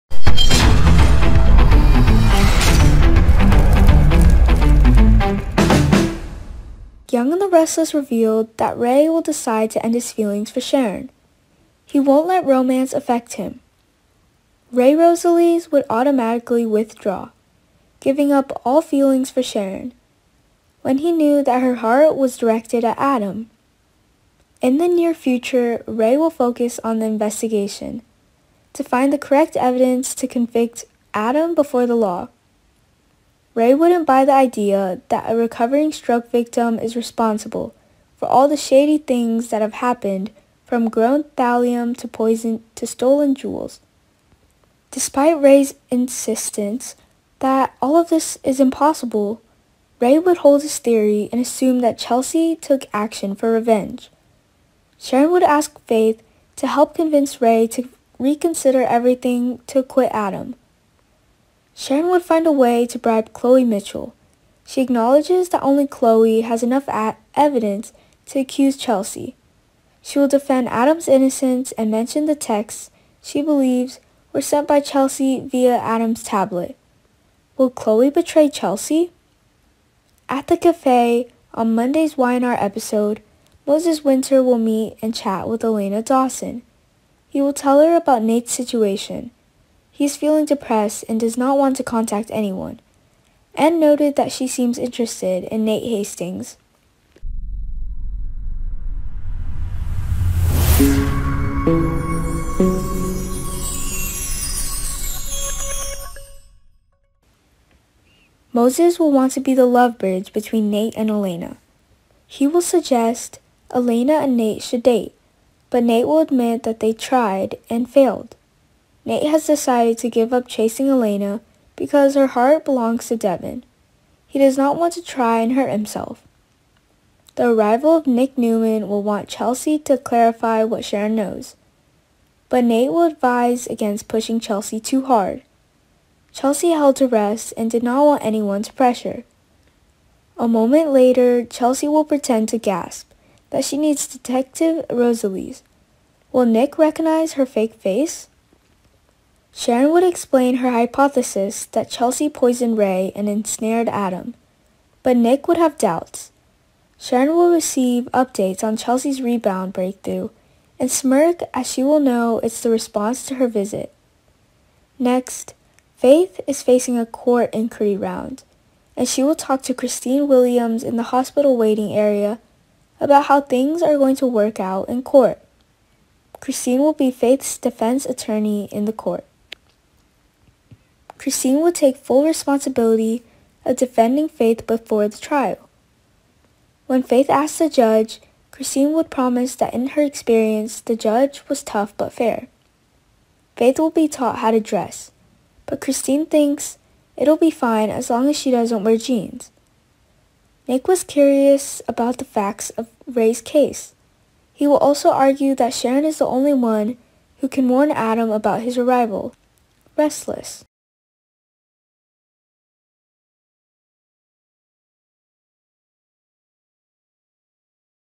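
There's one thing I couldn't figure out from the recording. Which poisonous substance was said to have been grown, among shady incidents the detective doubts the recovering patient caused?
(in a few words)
Thallium.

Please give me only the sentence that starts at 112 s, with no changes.
He will suggest Elena and Nate should date, but Nate will admit that they tried and failed.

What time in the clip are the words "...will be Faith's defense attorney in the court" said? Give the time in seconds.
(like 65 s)
176 s.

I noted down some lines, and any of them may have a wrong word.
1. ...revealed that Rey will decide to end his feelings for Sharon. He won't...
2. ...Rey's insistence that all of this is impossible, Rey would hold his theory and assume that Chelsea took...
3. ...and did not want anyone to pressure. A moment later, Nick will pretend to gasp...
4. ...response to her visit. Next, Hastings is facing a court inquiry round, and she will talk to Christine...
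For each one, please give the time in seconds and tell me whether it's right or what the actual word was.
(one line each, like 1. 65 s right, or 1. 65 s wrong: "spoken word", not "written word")
1. 7 s right
2. 45 s right
3. 137 s wrong: "Chelsea", not "Nick"
4. 162 s wrong: "Faith", not "Hastings".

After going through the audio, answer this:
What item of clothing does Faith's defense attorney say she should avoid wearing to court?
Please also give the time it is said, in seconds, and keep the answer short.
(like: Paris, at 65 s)
Jeans, at 198 s.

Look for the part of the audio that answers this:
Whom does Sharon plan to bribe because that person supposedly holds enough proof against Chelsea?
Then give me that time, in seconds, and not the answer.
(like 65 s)
63 s.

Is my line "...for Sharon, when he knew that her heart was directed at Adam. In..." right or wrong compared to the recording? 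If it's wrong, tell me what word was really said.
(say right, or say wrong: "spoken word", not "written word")
right.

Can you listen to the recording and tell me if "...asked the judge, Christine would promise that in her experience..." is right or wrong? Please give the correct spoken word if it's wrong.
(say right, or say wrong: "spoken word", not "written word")
right.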